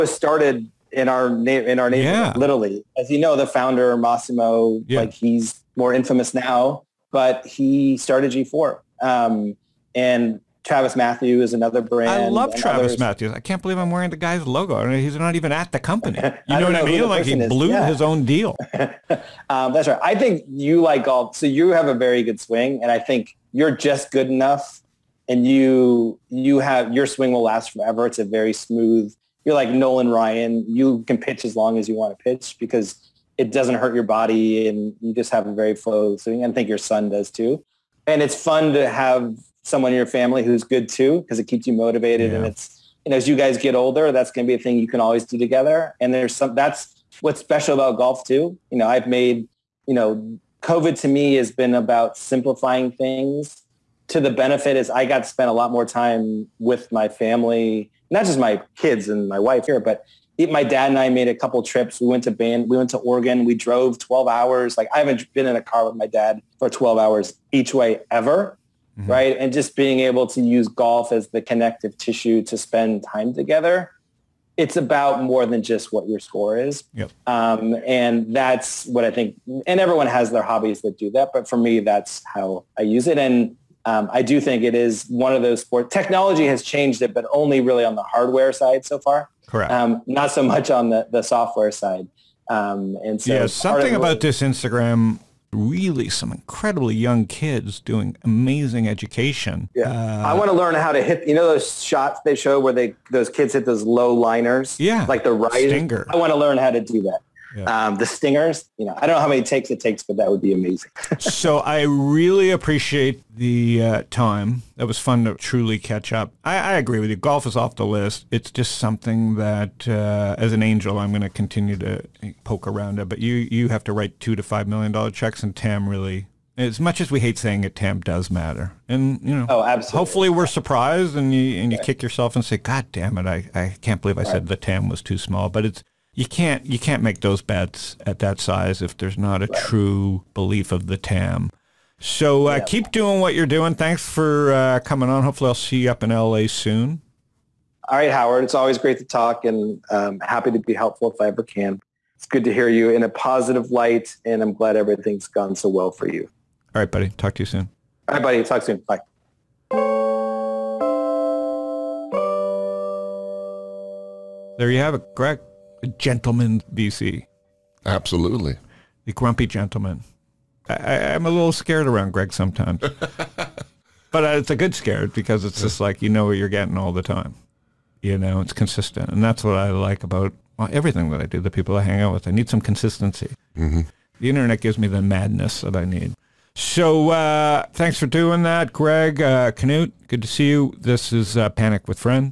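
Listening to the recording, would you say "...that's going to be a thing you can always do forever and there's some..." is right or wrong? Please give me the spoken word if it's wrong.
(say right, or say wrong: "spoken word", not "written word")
wrong: "together", not "forever".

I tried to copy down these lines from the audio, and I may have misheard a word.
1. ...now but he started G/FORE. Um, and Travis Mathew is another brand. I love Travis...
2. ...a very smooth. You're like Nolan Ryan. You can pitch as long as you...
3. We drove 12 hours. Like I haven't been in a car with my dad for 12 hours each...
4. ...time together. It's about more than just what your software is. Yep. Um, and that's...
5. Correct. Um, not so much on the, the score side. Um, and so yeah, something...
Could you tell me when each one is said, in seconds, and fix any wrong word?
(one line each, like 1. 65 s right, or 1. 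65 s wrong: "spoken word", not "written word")
1. 6 s right
2. 28 s right
3. 63 s right
4. 73 s wrong: "score", not "software"
5. 89 s wrong: "software", not "score".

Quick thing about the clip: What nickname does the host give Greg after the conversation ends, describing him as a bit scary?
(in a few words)
The grumpy gentleman.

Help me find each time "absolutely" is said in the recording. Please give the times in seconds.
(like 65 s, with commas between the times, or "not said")
129 s, 167 s.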